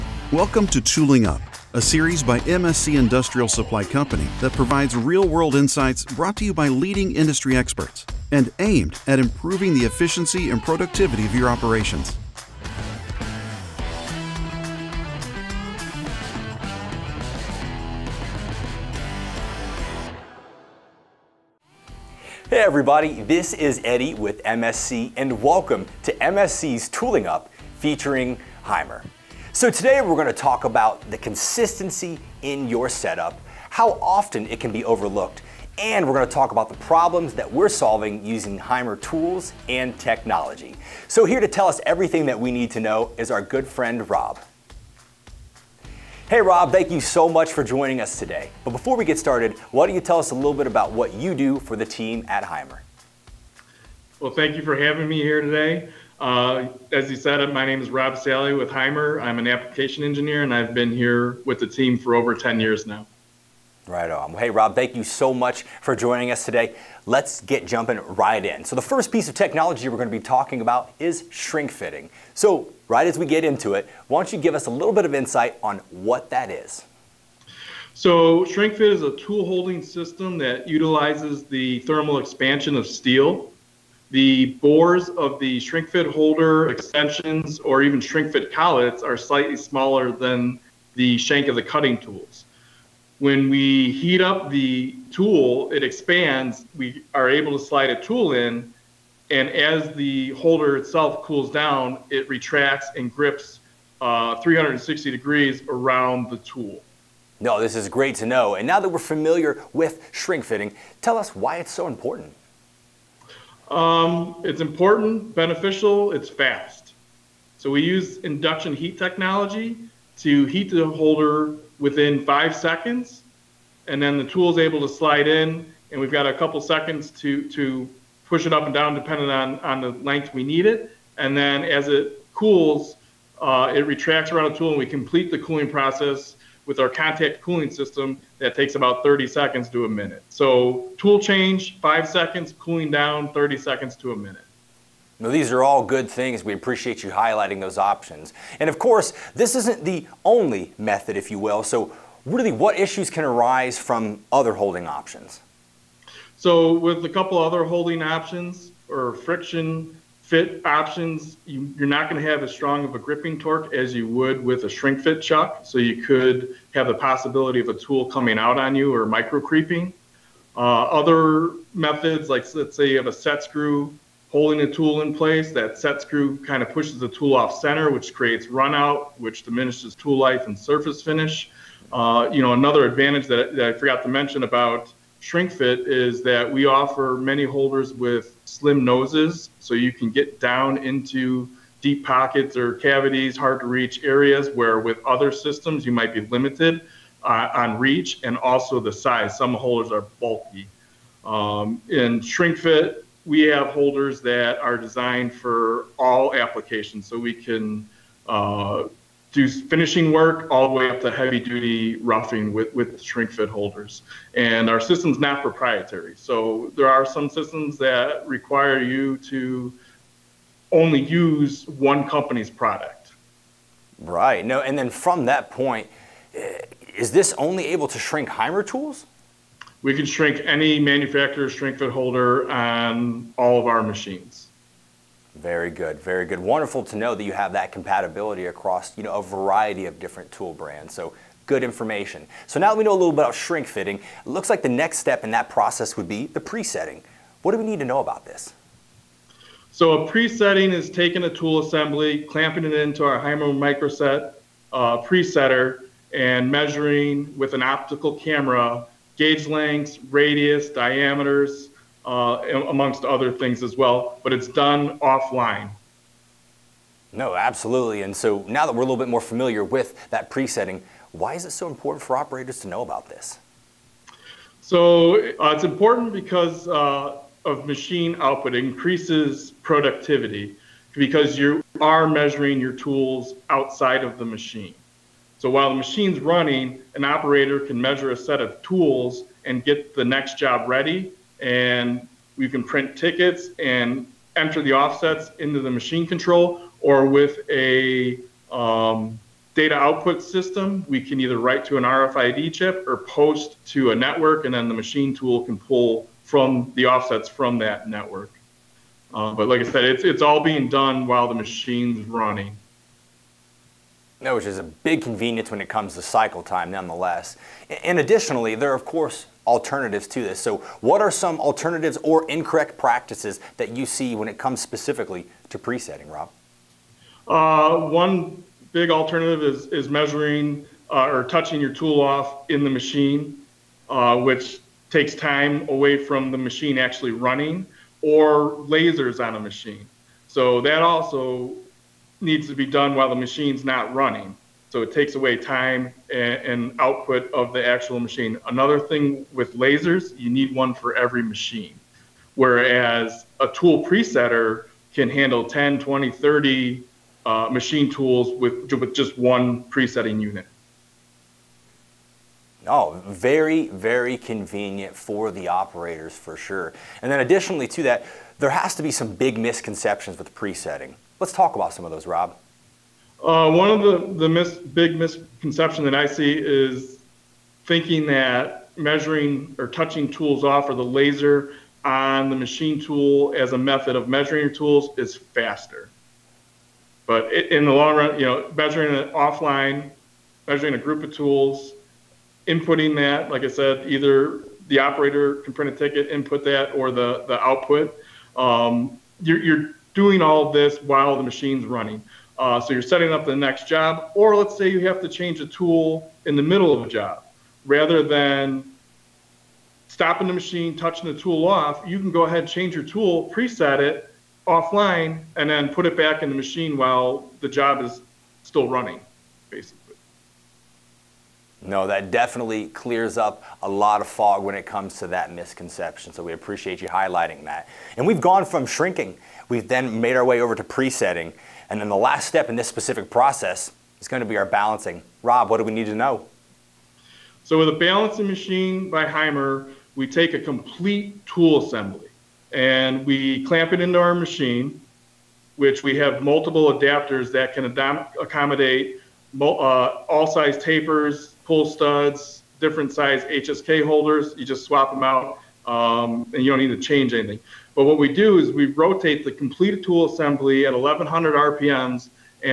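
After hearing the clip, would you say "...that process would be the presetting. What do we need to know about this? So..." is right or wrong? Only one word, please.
right.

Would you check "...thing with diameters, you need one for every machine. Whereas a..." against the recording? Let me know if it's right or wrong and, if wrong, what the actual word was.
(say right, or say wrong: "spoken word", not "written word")
wrong: "lasers", not "diameters".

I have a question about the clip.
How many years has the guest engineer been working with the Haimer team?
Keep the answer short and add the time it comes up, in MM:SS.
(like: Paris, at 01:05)
Over 10 years, at 01:02.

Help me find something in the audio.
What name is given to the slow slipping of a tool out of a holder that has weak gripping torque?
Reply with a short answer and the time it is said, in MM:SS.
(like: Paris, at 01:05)
Micro creeping, at 02:49.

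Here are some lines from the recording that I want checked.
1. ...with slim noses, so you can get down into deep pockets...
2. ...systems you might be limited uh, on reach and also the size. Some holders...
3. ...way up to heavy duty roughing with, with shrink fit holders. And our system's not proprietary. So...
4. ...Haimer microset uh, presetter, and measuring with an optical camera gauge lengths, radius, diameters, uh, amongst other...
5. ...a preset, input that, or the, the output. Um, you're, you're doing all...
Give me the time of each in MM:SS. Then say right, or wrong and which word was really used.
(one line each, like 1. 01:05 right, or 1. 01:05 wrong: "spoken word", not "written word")
1. 03:07 right
2. 03:15 right
3. 03:30 right
4. 04:13 right
5. 06:35 wrong: "ticket", not "preset".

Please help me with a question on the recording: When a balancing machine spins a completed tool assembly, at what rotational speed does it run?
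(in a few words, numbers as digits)
1100 RPM.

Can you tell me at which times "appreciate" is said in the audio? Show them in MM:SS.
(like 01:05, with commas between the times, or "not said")
02:26, 07:06.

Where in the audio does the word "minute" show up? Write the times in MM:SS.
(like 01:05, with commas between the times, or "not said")
02:19, 02:24.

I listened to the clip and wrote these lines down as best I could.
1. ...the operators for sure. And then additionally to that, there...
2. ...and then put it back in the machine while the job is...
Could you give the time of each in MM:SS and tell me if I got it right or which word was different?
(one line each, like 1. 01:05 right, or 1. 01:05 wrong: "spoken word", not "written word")
1. 06:05 right
2. 06:55 right.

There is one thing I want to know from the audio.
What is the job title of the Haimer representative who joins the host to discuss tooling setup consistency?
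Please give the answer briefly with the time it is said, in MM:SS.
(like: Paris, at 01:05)
Application engineer, at 00:59.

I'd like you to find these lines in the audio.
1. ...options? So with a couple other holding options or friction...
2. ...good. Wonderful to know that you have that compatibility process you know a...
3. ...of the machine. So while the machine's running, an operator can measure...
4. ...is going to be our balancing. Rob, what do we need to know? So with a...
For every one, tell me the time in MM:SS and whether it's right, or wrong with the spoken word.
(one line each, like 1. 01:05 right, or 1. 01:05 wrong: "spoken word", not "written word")
1. 02:34 right
2. 03:56 wrong: "across", not "process"
3. 04:44 right
4. 07:13 right.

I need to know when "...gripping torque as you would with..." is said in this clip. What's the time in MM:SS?
02:42.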